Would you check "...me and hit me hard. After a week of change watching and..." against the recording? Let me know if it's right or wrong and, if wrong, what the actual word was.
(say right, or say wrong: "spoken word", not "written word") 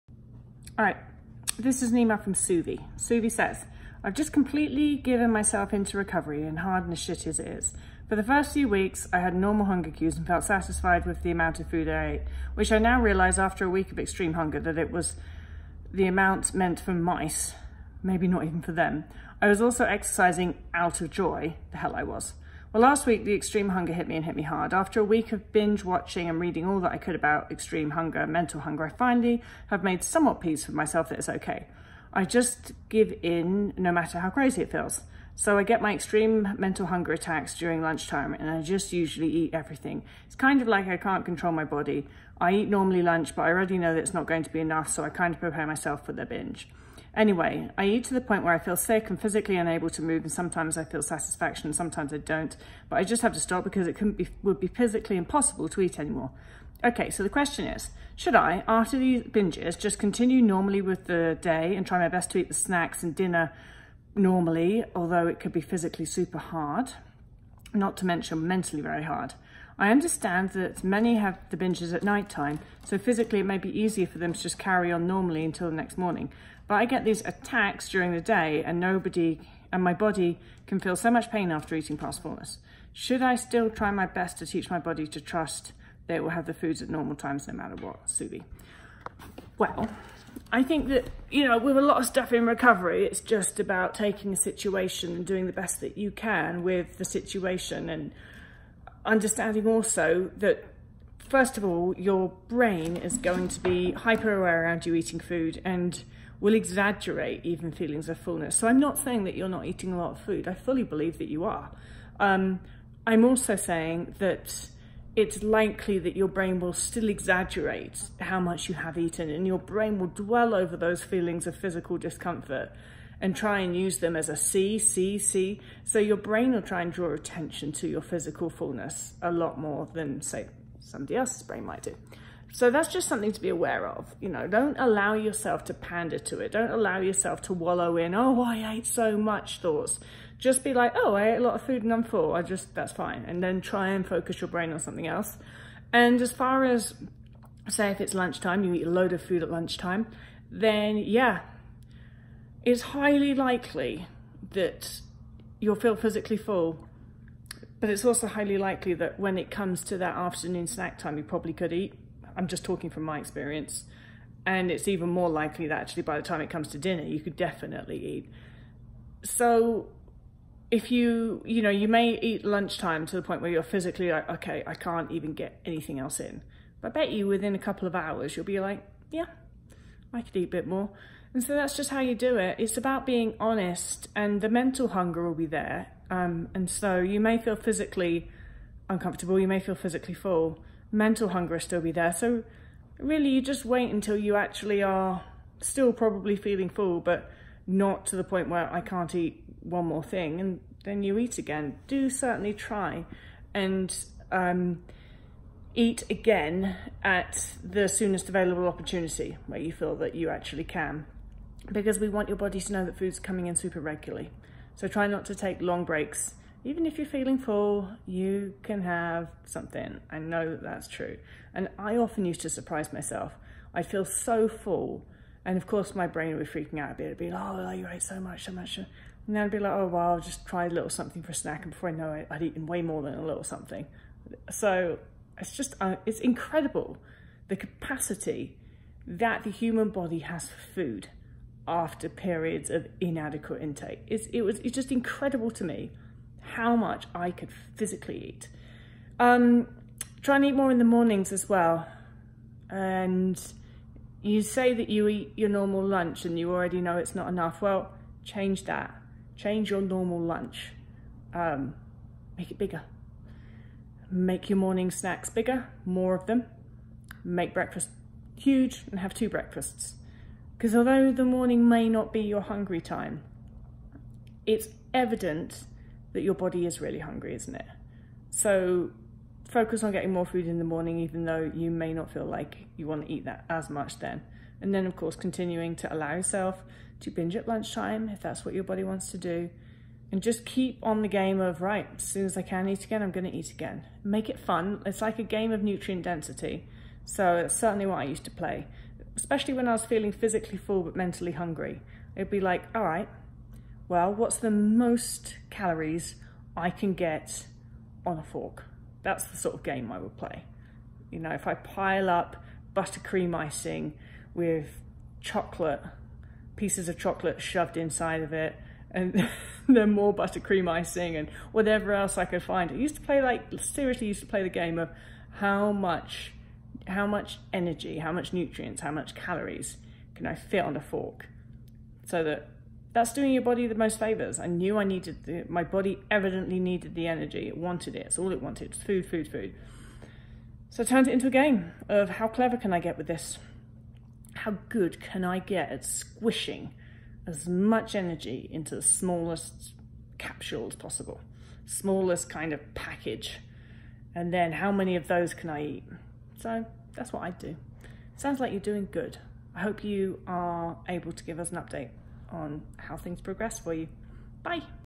wrong: "binge", not "change".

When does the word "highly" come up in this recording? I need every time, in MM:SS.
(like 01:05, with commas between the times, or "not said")
02:32, 02:38.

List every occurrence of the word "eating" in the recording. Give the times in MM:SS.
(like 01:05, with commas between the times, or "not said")
01:21, 01:44, 01:49.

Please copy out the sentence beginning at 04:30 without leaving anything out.
Because although the morning may not be your hungry time, it's evident that your body is really hungry, isn't it?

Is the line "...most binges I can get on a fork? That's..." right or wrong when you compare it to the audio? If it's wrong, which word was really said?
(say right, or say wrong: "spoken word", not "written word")
wrong: "calories", not "binges".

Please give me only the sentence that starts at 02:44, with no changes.
And it's even more likely that actually by the time it comes to dinner, you could definitely eat.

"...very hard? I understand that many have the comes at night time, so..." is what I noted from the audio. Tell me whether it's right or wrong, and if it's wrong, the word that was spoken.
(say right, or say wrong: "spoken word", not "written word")
wrong: "binges", not "comes".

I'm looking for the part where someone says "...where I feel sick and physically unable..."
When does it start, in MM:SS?
00:48.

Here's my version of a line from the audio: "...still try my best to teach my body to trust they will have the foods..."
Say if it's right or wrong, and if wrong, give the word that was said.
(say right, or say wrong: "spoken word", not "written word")
right.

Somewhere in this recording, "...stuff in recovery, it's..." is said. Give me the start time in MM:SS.
01:32.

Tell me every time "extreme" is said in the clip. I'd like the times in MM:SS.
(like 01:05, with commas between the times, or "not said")
00:13, 00:23, 00:27, 00:35.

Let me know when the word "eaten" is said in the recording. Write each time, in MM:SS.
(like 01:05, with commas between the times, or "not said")
01:58, 03:52.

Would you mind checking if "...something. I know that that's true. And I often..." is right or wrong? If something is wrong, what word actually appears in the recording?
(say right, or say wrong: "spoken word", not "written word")
right.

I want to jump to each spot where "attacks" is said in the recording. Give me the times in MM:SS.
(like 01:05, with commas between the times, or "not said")
00:37, 01:17.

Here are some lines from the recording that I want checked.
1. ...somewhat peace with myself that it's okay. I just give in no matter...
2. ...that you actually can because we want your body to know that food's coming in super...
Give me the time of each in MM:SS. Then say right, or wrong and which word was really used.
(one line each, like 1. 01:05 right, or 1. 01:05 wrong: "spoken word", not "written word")
1. 00:30 right
2. 03:29 right.